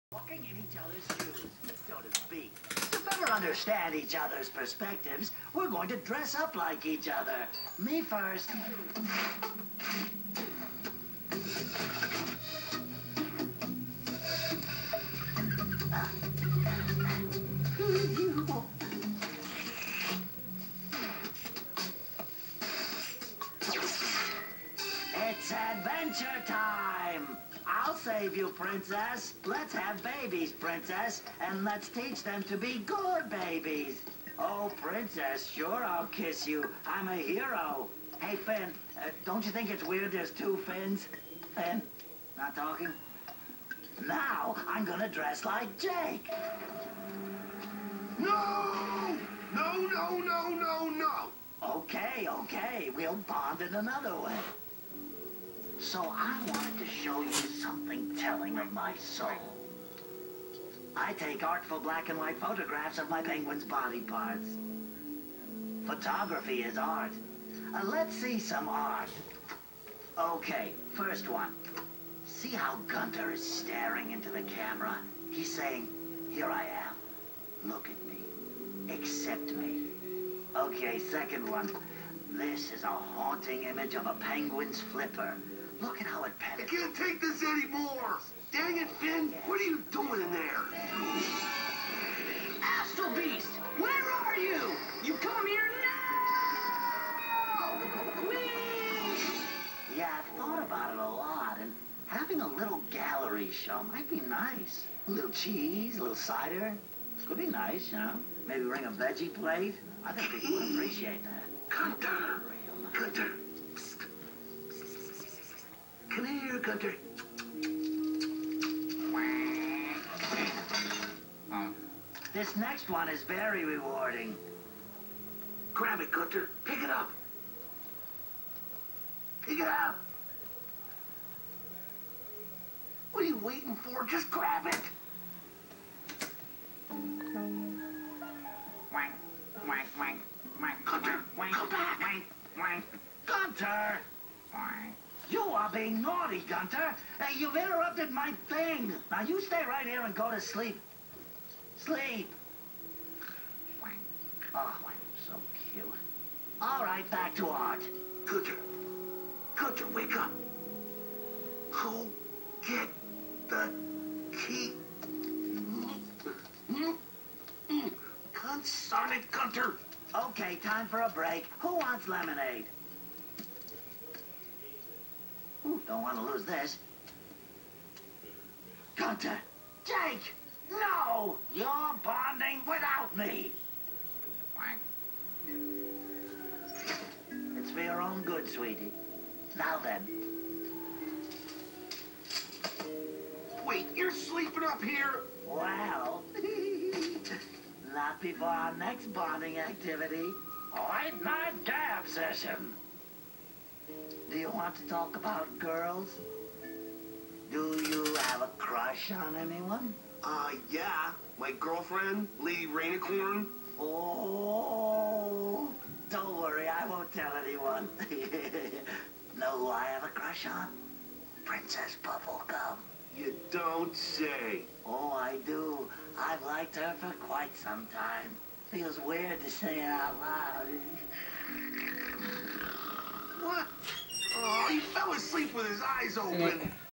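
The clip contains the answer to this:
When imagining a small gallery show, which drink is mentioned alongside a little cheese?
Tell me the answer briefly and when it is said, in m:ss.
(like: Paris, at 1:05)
Cider, at 1:46.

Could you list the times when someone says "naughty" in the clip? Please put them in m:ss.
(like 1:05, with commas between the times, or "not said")
2:26.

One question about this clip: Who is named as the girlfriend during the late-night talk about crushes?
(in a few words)
Lady Rainicorn.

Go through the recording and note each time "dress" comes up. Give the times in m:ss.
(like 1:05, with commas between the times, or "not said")
0:05, 0:45.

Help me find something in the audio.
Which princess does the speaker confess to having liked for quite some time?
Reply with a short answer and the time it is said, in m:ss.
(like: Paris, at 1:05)
Princess Bubblegum, at 3:41.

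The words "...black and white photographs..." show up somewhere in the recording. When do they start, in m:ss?
1:01.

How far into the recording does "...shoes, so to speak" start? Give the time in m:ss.
0:01.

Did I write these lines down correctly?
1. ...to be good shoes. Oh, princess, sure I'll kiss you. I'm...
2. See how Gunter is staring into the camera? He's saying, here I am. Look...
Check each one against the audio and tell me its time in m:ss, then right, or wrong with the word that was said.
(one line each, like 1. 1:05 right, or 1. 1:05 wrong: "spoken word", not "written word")
1. 0:32 wrong: "babies", not "shoes"
2. 1:12 right.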